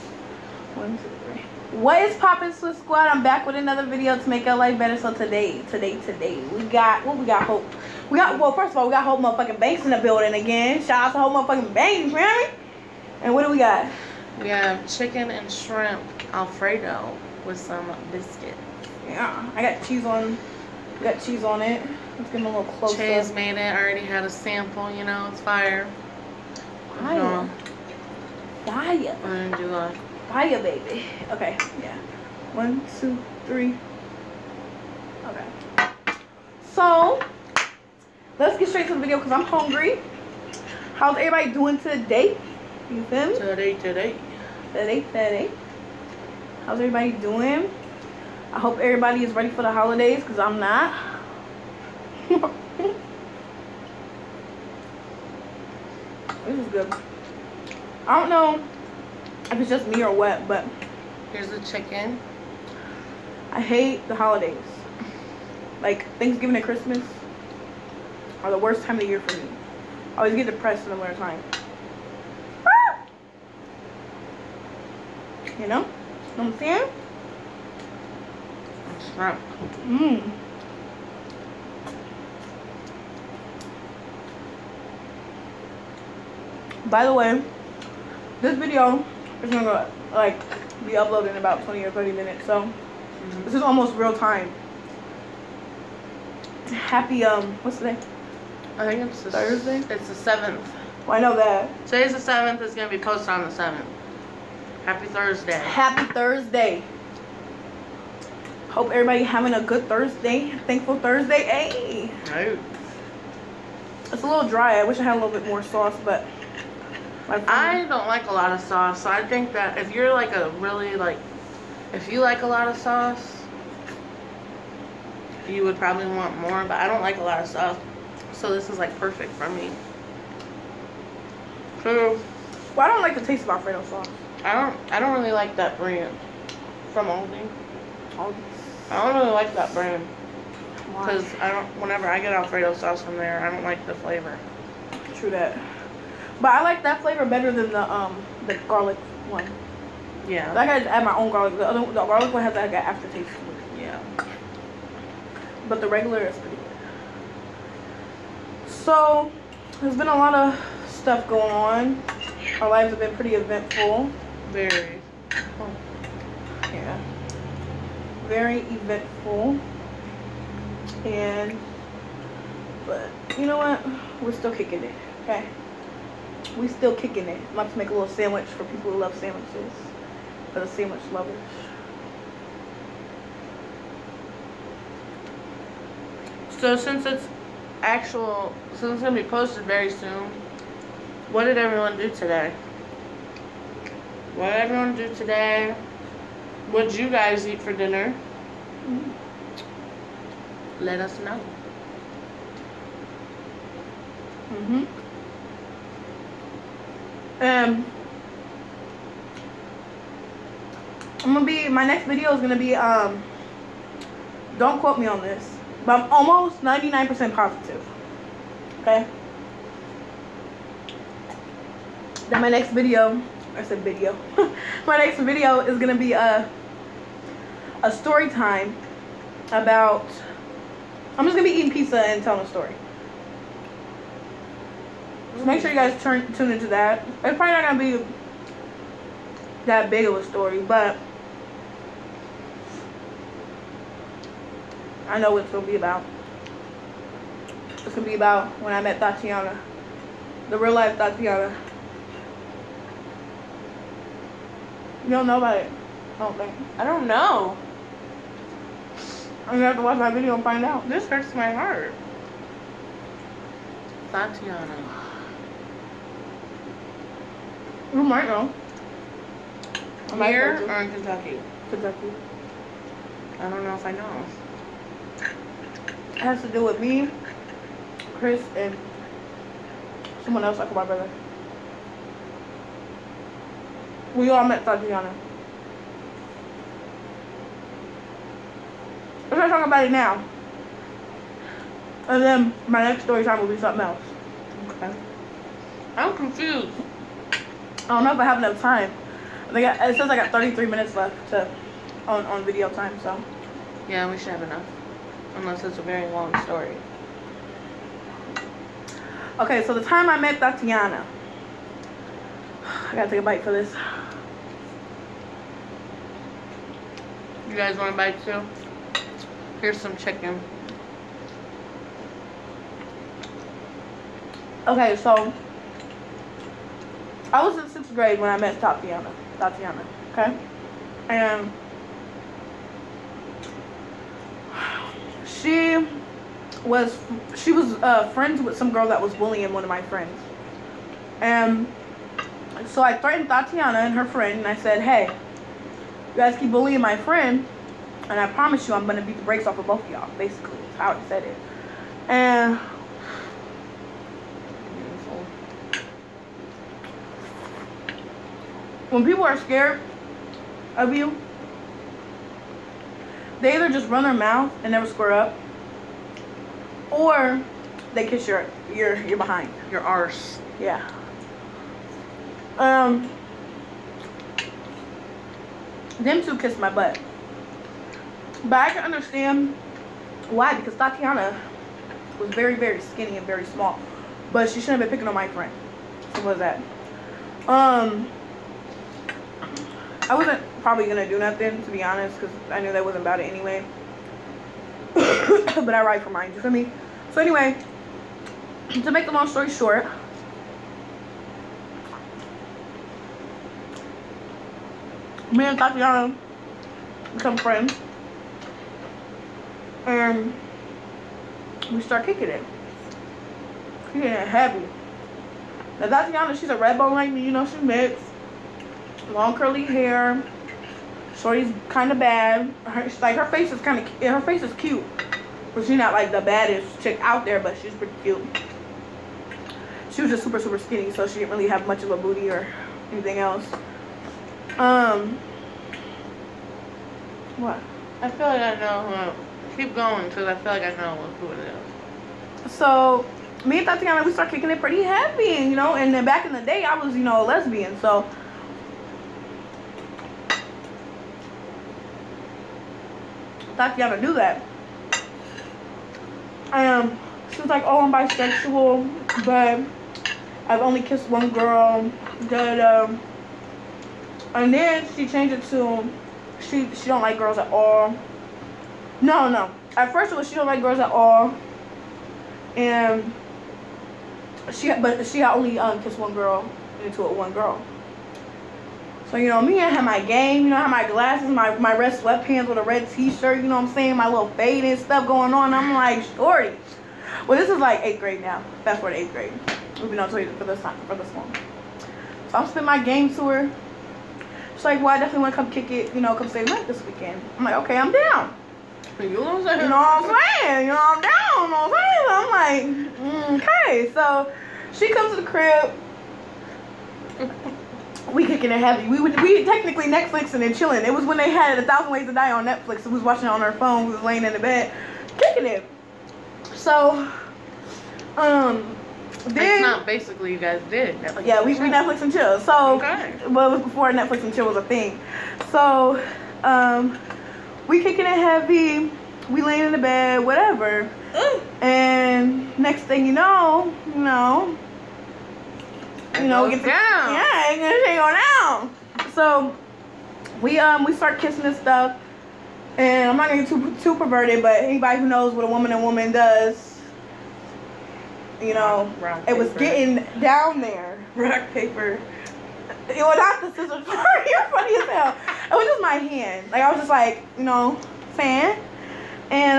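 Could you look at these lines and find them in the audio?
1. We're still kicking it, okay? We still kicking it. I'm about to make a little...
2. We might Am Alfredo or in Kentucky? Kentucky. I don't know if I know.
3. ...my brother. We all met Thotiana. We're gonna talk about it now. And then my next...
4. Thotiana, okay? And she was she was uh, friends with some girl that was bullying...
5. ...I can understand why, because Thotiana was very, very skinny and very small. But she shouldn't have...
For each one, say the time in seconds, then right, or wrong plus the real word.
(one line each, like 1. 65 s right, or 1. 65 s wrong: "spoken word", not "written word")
1. 174 s right
2. 267 s wrong: "Here", not "Alfredo"
3. 280 s right
4. 329 s right
5. 378 s right.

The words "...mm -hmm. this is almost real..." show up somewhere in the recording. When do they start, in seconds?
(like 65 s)
92 s.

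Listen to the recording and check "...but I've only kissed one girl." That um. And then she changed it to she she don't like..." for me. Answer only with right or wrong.
right.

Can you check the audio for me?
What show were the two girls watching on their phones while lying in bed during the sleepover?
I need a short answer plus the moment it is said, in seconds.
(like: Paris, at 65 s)
A Thousand Ways to Die, at 511 s.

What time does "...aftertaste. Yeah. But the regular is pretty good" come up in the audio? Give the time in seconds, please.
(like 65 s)
152 s.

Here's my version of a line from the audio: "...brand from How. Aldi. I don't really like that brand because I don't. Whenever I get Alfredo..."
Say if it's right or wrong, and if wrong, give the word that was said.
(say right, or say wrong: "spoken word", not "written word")
wrong: "Aldi", not "How".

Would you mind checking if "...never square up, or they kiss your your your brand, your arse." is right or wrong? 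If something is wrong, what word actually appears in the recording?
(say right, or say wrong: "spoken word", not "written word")
wrong: "behind", not "brand".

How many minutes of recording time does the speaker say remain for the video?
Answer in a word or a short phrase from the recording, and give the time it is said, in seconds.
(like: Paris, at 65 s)
33 minutes, at 300 s.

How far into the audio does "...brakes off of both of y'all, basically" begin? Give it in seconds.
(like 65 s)
349 s.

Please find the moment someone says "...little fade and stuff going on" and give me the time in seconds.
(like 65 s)
484 s.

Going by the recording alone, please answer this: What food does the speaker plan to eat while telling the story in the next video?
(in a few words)
Pizza.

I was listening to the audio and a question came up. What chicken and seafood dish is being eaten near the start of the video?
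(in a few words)
Chicken and shrimp alfredo.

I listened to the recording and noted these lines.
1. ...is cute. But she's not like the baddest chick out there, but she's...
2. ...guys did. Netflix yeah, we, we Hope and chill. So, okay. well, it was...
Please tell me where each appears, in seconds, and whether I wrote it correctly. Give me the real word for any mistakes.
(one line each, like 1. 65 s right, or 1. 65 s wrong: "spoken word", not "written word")
1. 424 s right
2. 520 s wrong: "Netflix", not "Hope".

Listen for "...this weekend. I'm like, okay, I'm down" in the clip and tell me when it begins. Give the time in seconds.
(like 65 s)
496 s.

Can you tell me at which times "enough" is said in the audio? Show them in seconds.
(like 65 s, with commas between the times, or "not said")
298 s, 304 s.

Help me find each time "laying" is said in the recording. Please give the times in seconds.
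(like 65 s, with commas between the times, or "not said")
514 s, 529 s.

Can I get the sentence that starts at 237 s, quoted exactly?
It's probably not gonna be that big of a story, but I know what it's gonna be about.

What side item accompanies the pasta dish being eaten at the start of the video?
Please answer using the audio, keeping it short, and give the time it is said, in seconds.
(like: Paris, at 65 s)
Biscuit, at 18 s.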